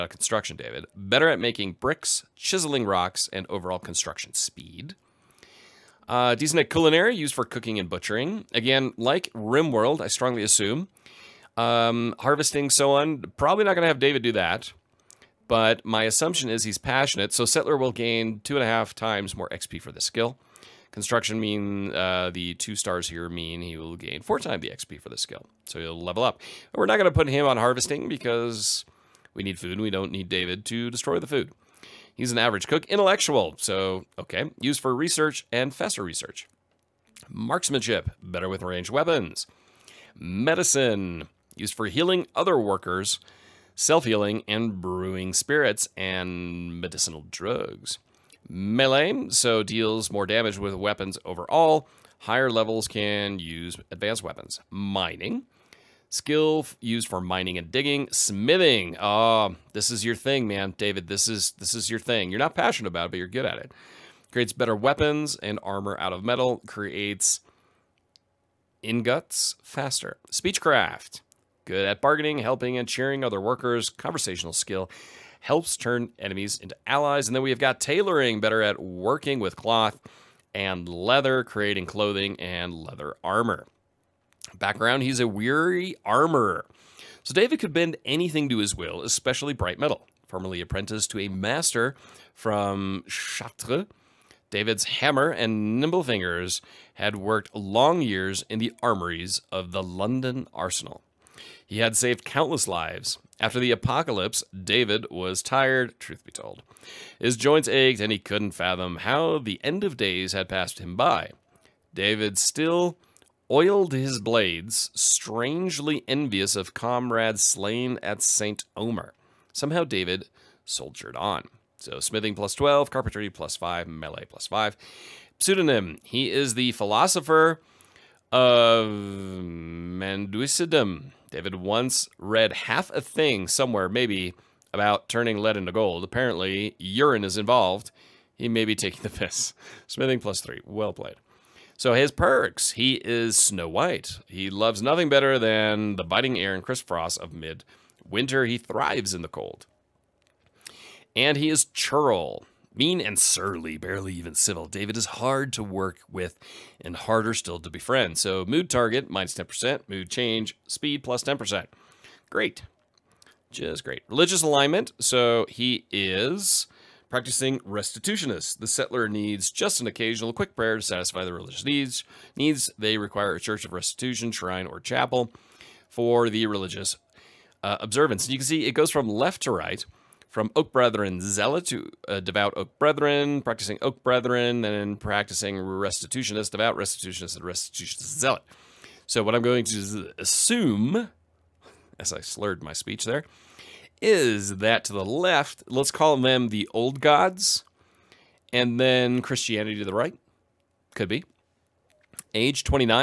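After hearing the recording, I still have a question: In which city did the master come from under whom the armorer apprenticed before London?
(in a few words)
Chartres.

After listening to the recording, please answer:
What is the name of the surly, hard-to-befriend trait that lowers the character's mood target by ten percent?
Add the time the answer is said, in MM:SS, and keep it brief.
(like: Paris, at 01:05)
Churl, at 02:31.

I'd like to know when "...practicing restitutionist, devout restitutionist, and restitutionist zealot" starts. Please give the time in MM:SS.
03:04.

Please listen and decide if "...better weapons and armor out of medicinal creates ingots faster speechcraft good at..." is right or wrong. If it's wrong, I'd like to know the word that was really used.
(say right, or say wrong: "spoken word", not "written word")
wrong: "metal", not "medicinal".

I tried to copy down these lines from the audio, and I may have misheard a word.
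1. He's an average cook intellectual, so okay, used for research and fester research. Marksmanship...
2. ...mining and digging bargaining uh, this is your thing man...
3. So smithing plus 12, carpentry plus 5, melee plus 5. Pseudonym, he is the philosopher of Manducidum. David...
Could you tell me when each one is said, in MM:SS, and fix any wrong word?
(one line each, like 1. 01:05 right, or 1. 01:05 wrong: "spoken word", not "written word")
1. 00:32 right
2. 00:57 wrong: "smithing", not "bargaining"
3. 02:01 right.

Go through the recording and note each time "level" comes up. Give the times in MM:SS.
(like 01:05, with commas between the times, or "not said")
00:26, 00:52.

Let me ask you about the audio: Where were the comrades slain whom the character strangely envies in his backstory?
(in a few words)
St. Omer.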